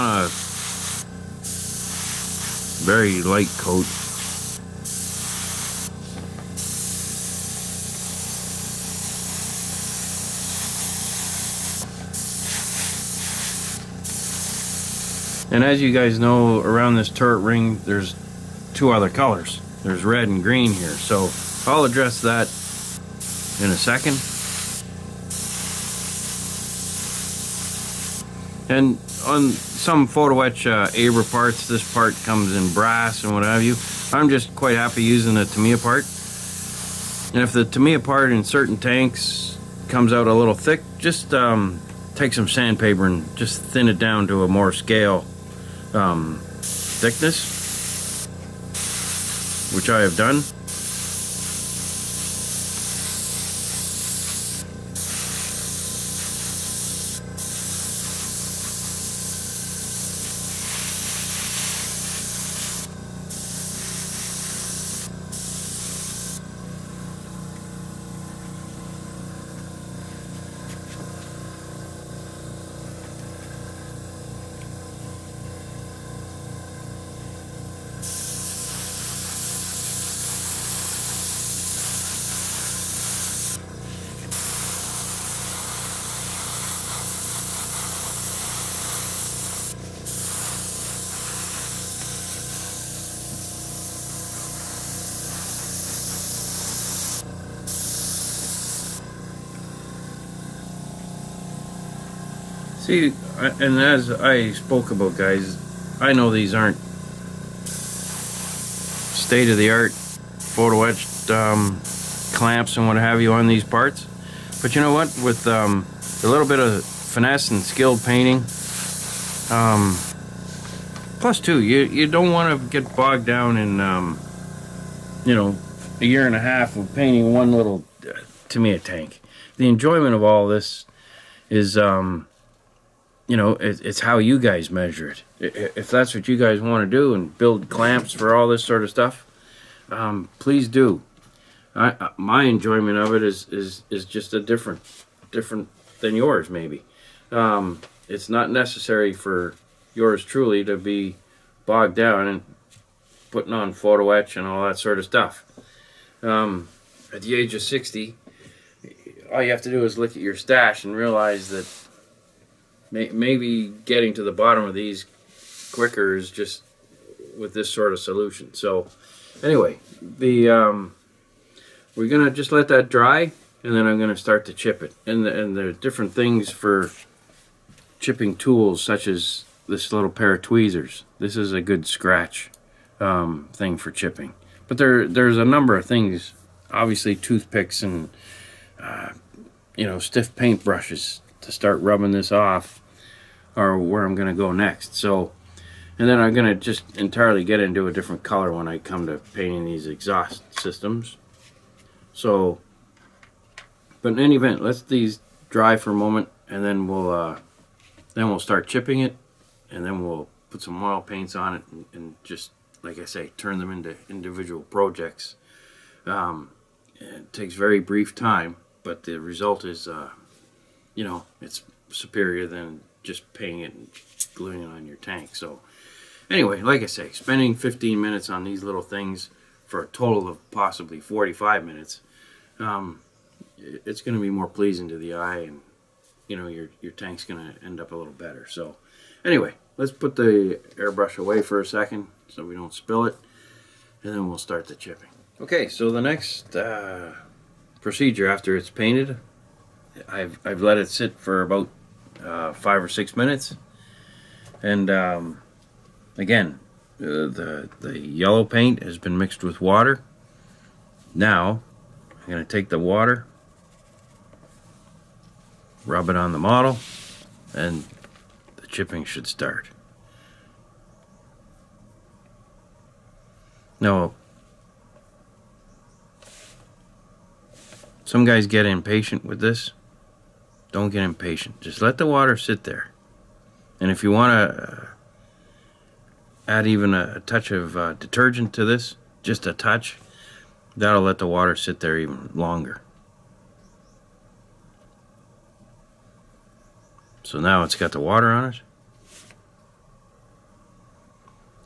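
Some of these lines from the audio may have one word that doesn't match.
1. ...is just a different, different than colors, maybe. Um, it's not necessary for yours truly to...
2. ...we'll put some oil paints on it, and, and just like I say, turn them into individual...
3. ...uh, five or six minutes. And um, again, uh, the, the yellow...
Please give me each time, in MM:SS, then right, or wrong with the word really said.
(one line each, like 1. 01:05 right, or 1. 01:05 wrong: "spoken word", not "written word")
1. 02:23 wrong: "yours", not "colors"
2. 03:30 right
3. 04:12 right.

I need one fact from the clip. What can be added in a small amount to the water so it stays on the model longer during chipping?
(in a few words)
Detergent.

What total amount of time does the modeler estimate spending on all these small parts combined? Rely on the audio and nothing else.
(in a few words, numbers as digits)
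45 minutes.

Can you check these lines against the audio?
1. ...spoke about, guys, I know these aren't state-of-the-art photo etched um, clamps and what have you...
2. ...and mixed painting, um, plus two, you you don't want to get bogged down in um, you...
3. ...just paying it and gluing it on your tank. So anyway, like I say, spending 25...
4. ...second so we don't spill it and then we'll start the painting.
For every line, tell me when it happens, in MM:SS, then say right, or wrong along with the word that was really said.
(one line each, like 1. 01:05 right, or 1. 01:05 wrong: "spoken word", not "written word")
1. 01:44 right
2. 01:57 wrong: "skilled", not "mixed"
3. 03:43 wrong: "15", not "25"
4. 04:01 wrong: "chipping", not "painting".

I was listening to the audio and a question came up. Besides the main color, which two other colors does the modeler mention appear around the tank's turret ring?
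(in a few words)
Red and green.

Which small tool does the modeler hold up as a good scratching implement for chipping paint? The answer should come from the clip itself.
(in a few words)
Tweezers.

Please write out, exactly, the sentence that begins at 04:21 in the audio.
Now, I'm going to take the water, rub it on the model, and the chipping should start.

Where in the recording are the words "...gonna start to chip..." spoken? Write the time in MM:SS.
02:53.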